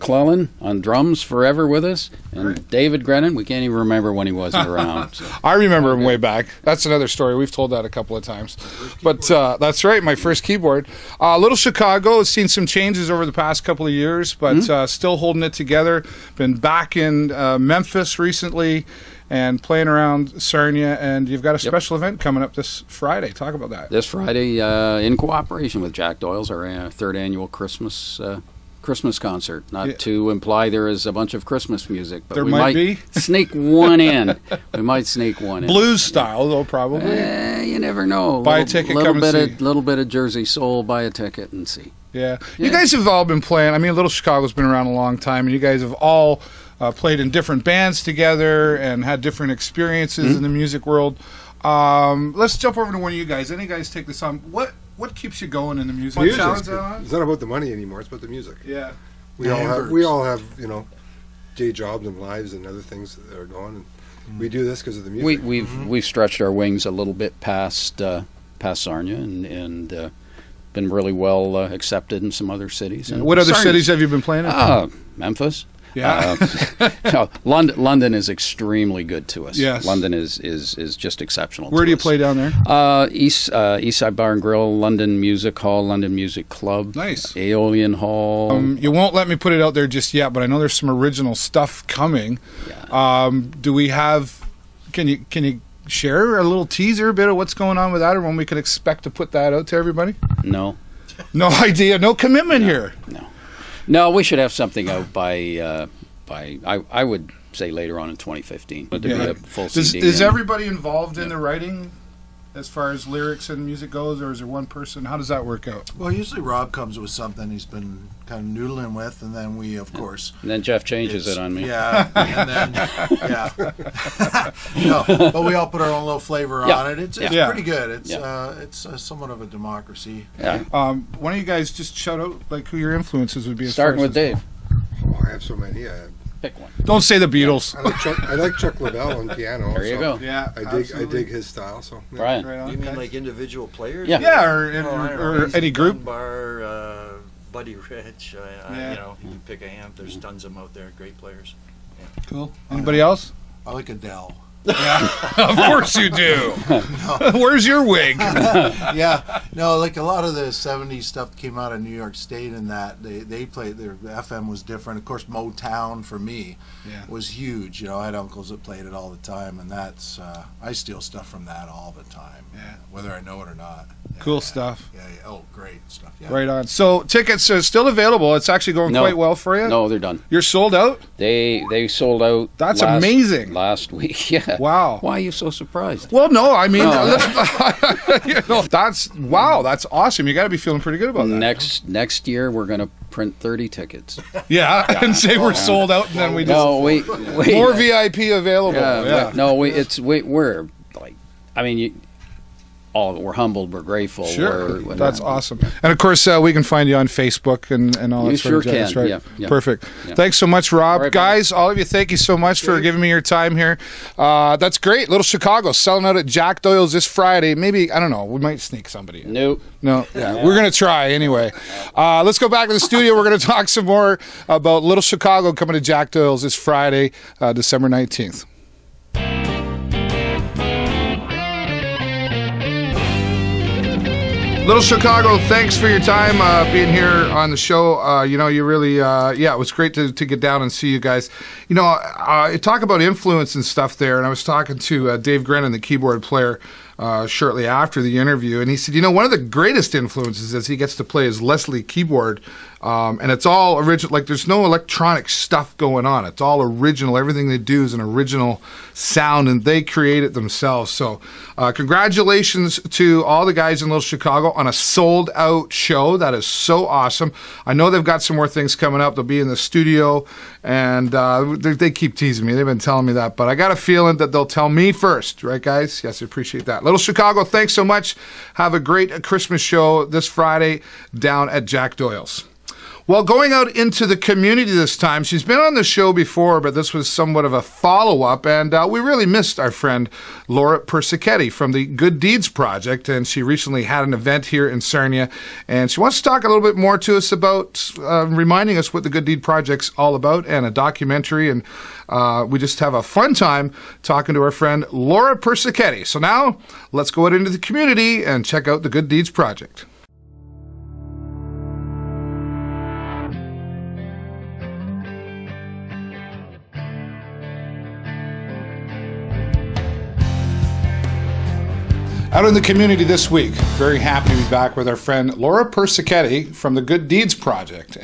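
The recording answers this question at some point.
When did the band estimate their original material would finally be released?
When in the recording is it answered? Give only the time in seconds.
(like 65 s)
107 s.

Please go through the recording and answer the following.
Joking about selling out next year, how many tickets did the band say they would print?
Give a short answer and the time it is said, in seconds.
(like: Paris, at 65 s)
30, at 193 s.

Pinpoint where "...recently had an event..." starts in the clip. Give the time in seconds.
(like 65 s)
293 s.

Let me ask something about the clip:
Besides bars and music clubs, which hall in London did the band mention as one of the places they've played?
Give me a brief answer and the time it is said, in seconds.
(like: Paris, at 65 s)
Aeolian Hall, at 87 s.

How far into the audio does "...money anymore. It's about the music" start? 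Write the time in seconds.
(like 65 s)
57 s.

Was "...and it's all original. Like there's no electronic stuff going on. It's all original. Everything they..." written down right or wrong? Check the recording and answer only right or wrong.
right.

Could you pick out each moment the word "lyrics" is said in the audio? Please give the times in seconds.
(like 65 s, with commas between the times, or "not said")
113 s.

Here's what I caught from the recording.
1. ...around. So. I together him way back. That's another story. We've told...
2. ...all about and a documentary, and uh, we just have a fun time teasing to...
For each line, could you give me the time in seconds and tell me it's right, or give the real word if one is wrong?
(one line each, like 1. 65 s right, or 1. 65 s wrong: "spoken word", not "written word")
1. 4 s wrong: "remember", not "together"
2. 299 s wrong: "talking", not "teasing".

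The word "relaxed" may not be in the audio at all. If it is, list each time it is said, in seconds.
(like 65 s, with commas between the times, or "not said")
not said.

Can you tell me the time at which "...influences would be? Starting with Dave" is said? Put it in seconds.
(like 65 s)
132 s.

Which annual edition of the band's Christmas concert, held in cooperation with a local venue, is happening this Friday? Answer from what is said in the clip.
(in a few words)
third.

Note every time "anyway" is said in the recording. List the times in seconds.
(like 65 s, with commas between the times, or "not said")
221 s.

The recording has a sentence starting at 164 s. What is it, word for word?
Of course, Motown for me yeah.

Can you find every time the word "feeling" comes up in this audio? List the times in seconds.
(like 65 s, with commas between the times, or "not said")
190 s, 273 s.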